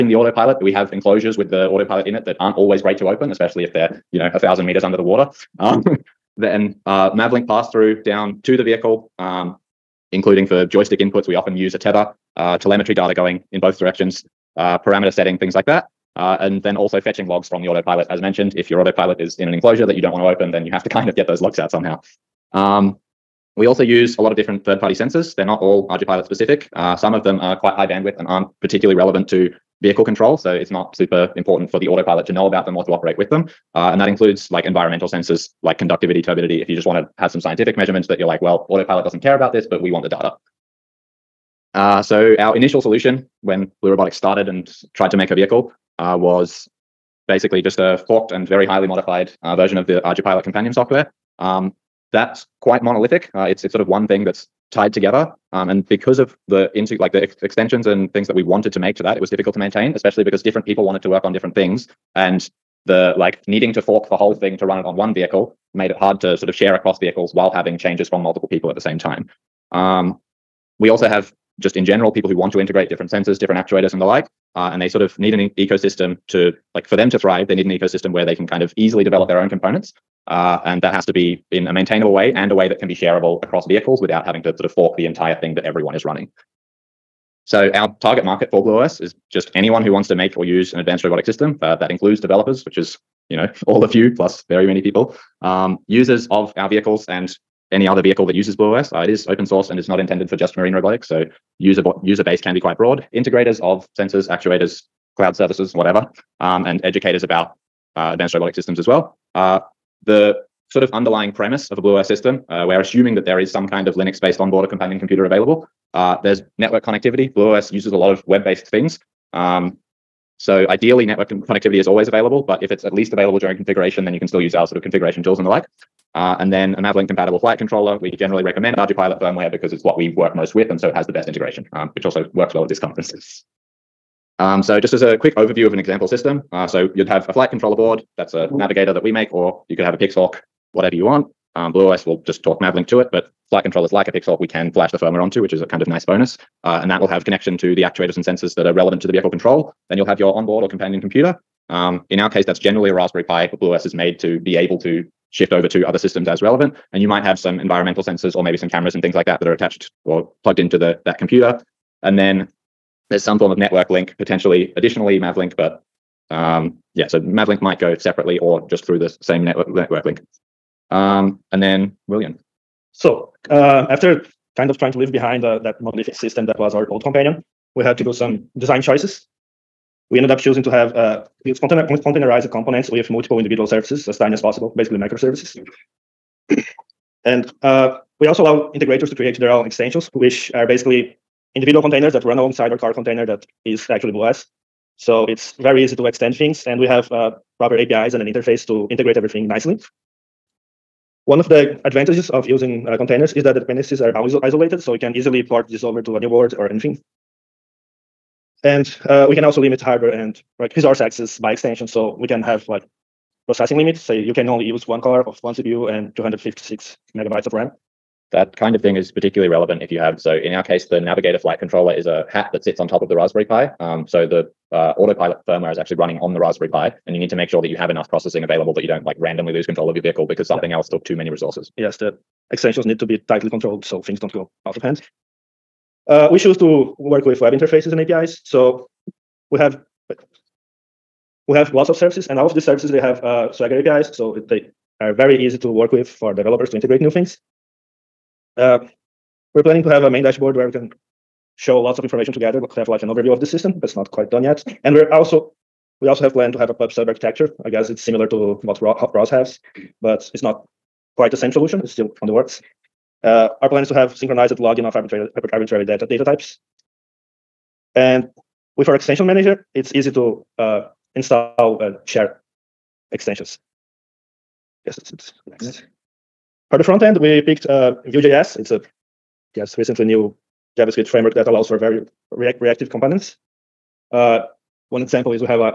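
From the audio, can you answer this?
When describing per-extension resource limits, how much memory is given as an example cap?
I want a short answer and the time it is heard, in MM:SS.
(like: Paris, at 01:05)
256 megabytes, at 03:36.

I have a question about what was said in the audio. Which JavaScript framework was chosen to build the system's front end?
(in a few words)
Vue.js.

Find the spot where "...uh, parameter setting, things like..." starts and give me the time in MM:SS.
00:14.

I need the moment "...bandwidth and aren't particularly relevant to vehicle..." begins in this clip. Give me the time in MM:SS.
00:27.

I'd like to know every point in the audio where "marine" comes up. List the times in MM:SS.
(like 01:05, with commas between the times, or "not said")
01:40.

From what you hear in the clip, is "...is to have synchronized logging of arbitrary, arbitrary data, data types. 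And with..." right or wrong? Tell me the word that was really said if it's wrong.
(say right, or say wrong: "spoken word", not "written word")
right.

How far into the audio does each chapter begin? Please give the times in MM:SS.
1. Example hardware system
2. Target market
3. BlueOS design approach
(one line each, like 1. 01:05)
1. 02:13
2. 01:26
3. 02:52.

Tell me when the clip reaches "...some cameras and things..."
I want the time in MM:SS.
02:38.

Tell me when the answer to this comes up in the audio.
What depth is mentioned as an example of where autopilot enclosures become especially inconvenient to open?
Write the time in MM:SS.
00:04.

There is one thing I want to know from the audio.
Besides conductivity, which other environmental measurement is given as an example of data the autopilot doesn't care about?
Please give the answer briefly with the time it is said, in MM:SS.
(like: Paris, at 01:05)
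Turbidity, at 00:36.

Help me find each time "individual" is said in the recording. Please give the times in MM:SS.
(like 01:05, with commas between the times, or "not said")
03:03, 03:11.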